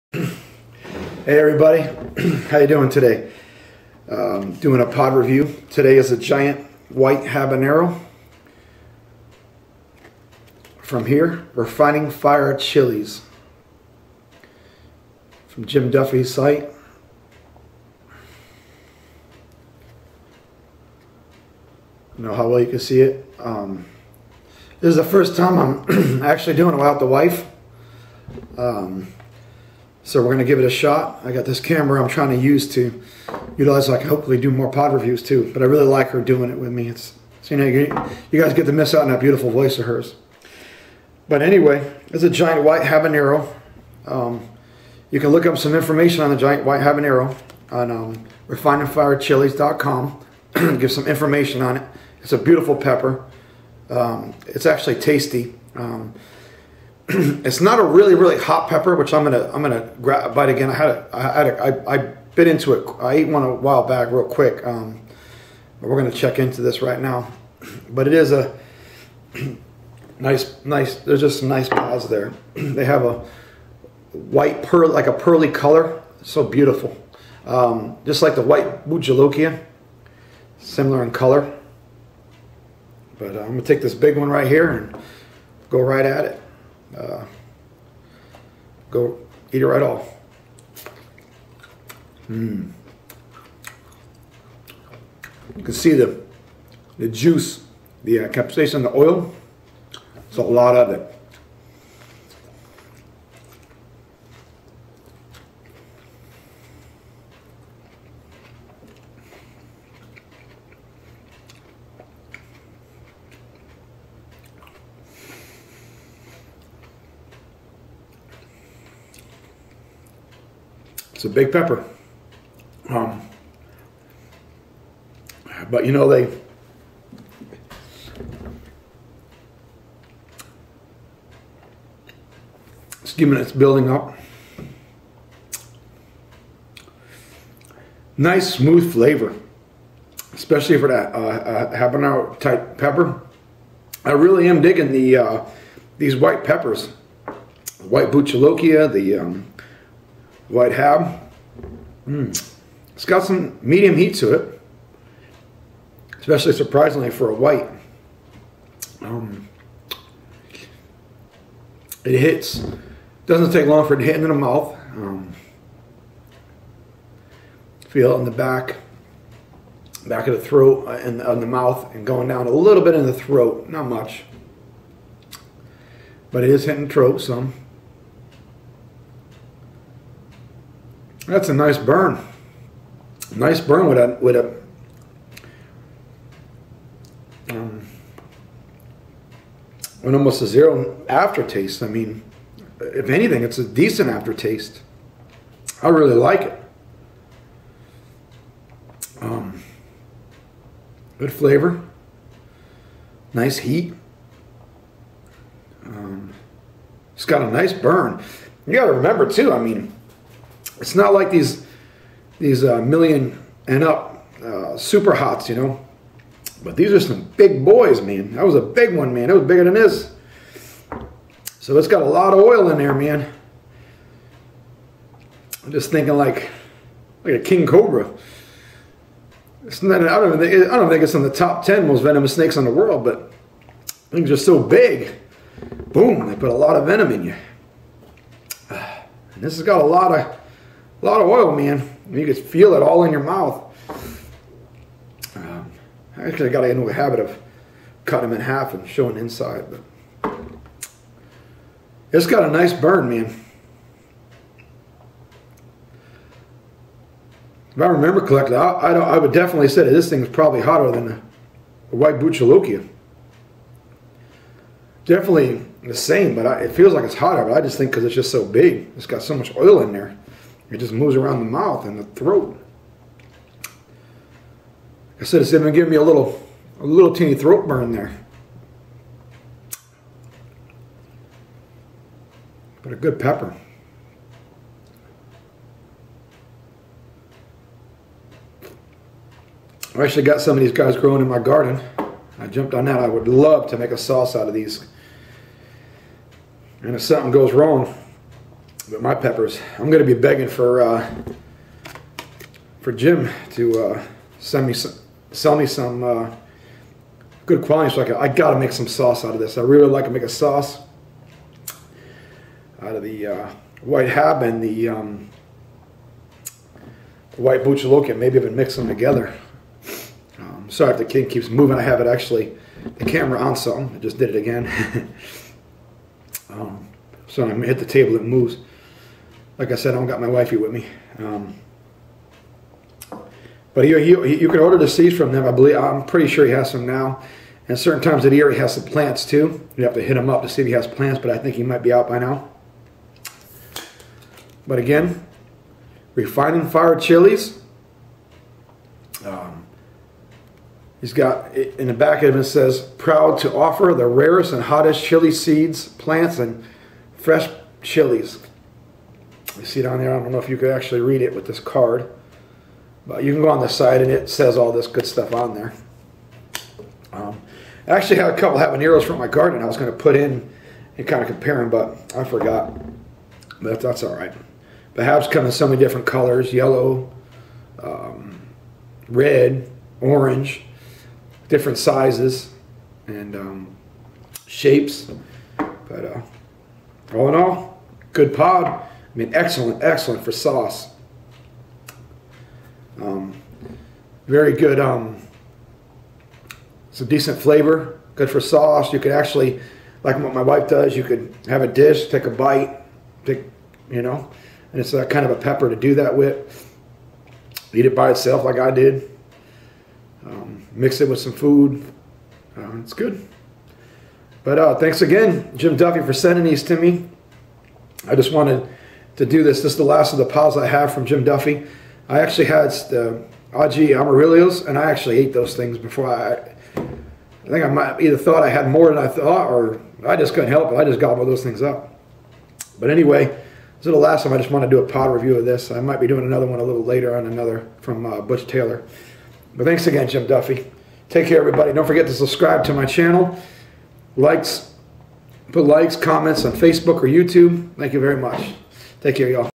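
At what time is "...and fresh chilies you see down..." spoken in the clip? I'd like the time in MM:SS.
05:56.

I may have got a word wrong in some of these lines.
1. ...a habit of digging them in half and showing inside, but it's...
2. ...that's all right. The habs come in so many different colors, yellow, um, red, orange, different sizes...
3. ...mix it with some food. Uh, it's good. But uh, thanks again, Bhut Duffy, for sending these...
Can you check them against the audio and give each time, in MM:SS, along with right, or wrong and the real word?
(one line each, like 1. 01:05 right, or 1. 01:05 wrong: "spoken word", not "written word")
1. 04:06 wrong: "cutting", not "digging"
2. 06:13 right
3. 06:50 wrong: "Jim", not "Bhut".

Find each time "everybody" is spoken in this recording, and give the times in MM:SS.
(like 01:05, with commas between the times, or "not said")
00:01, 07:21.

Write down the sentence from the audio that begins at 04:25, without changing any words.
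Definitely the same, but I, it feels like it's hotter, but I just think because it's just so big.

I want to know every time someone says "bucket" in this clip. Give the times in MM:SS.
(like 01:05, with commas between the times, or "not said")
not said.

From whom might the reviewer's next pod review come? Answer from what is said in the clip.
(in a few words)
Butch Taylor.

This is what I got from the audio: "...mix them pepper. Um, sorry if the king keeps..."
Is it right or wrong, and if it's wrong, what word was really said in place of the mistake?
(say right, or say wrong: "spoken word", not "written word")
wrong: "together", not "pepper".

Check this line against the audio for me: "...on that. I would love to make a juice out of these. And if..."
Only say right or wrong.
wrong.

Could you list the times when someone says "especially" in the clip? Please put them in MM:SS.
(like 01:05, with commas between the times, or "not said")
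02:20, 02:36.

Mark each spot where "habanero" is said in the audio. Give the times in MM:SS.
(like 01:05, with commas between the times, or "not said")
00:07, 00:42, 00:46, 02:21, 06:08.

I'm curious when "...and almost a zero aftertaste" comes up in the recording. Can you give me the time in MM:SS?
03:10.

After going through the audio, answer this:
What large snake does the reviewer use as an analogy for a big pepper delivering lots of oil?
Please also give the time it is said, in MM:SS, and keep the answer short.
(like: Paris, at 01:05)
king cobra, at 03:47.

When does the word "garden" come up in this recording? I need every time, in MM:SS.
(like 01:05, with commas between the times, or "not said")
04:51, 06:09.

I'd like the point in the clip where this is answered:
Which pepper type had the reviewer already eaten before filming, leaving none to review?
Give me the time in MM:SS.
07:03.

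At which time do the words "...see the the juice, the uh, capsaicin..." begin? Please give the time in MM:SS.
01:35.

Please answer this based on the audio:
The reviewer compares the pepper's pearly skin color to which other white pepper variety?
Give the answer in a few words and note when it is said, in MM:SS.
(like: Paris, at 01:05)
white Bujalokia, at 01:18.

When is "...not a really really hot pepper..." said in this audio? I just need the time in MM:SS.
00:57.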